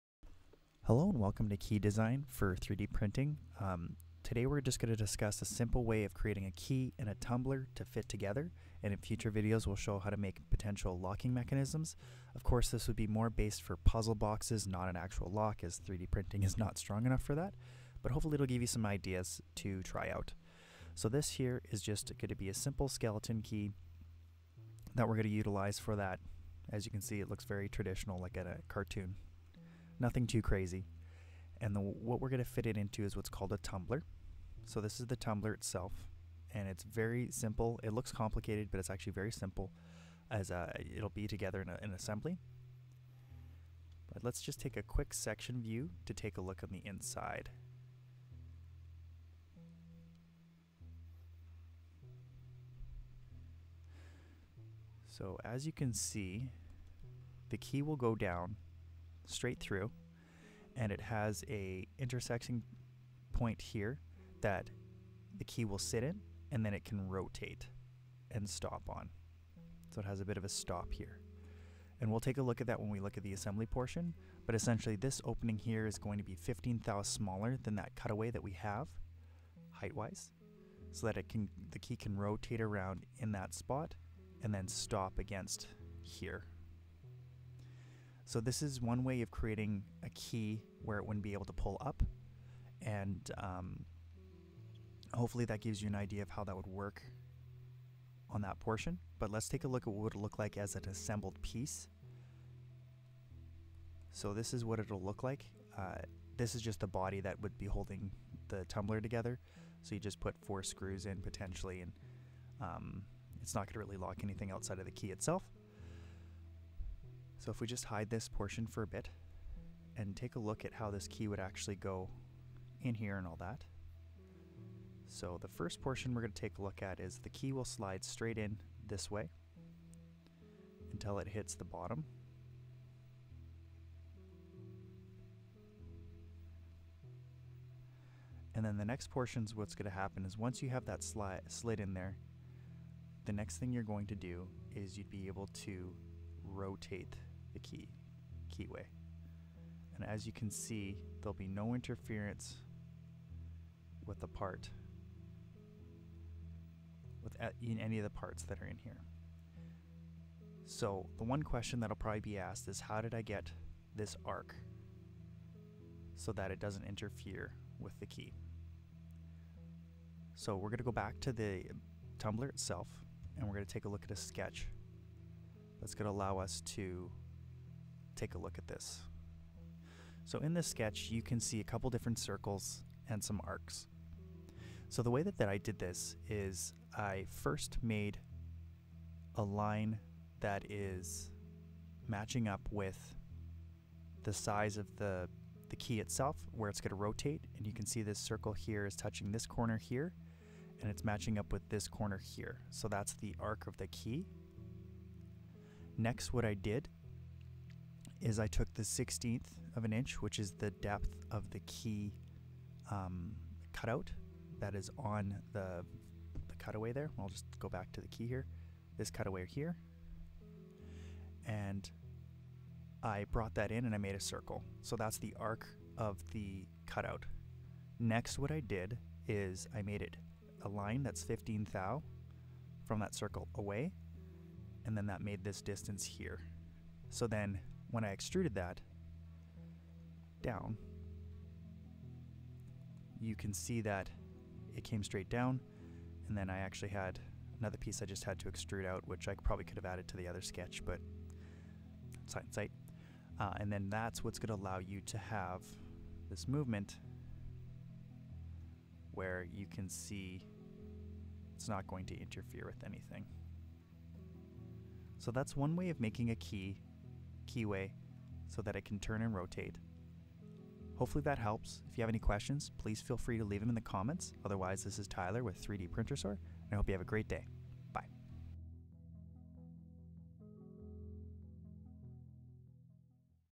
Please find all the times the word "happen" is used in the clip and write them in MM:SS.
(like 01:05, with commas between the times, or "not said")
02:19.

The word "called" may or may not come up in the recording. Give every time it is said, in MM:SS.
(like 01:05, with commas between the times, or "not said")
00:33.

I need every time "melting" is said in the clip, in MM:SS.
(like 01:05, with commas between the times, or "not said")
not said.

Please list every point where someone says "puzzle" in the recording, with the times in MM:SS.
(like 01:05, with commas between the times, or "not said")
00:13.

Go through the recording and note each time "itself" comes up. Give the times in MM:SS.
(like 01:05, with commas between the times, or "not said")
00:35, 01:55, 02:52, 03:15.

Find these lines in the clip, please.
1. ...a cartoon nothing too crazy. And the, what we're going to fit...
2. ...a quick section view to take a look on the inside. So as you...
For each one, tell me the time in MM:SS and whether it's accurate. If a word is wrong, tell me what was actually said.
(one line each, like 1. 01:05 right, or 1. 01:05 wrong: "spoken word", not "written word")
1. 00:28 right
2. 00:44 right.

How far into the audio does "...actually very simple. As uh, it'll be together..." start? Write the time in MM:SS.
00:38.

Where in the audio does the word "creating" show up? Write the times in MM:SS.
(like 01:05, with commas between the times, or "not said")
00:06, 01:29.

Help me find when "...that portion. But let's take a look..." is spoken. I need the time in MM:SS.
01:38.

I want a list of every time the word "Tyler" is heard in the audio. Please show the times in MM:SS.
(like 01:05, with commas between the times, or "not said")
04:35.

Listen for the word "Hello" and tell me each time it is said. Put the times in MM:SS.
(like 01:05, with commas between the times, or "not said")
00:00.